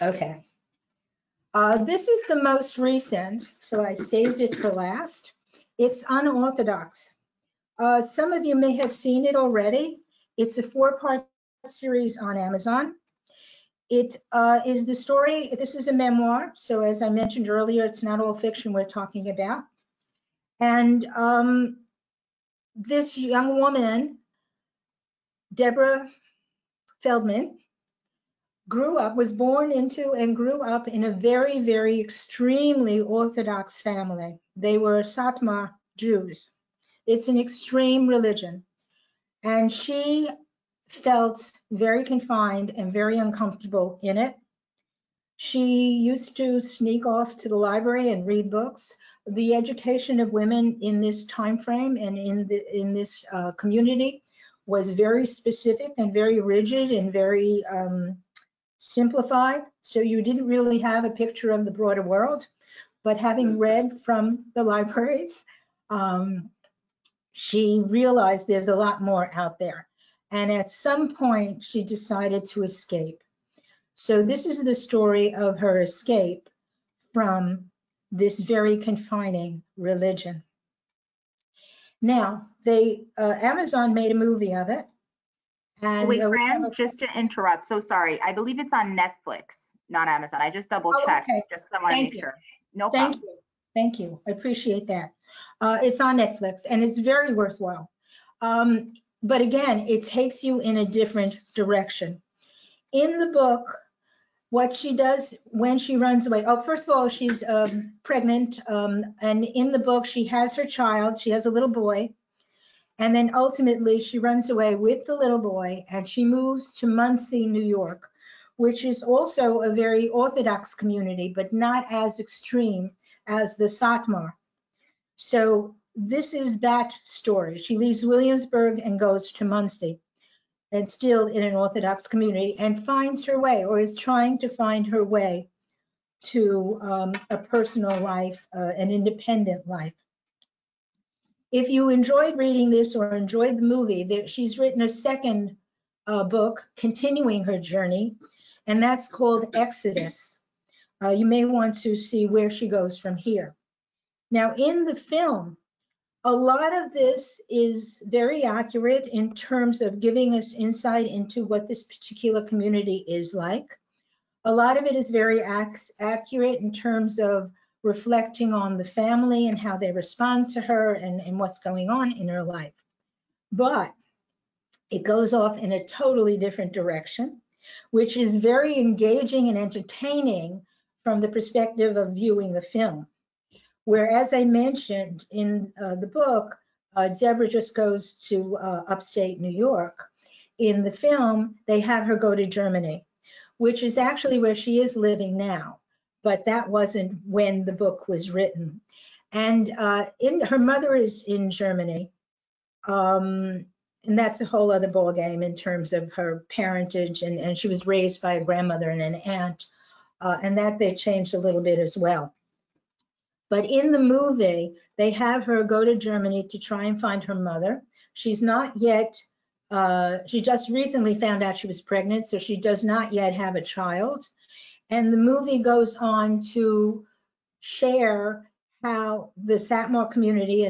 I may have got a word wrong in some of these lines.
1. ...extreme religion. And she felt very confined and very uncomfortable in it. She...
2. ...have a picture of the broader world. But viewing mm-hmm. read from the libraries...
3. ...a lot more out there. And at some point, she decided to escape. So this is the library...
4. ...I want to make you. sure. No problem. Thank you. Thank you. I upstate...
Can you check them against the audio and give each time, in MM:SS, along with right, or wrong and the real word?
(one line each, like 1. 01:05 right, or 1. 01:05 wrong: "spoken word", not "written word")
1. 00:37 right
2. 01:00 wrong: "having", not "viewing"
3. 01:08 wrong: "story", not "library"
4. 01:31 wrong: "appreciate", not "upstate".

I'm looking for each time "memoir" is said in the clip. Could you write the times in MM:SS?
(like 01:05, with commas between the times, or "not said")
00:15.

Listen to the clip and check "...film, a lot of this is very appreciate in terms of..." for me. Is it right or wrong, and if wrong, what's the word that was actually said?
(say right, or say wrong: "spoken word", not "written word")
wrong: "accurate", not "appreciate".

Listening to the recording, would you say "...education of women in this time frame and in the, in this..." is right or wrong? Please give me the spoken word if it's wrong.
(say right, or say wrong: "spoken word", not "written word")
right.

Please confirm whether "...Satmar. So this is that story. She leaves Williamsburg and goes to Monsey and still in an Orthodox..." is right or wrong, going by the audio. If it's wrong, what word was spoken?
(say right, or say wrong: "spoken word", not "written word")
right.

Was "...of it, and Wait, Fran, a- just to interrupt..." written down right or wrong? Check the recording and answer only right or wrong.
right.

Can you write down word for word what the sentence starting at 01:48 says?
Um, and in the book, she has her child.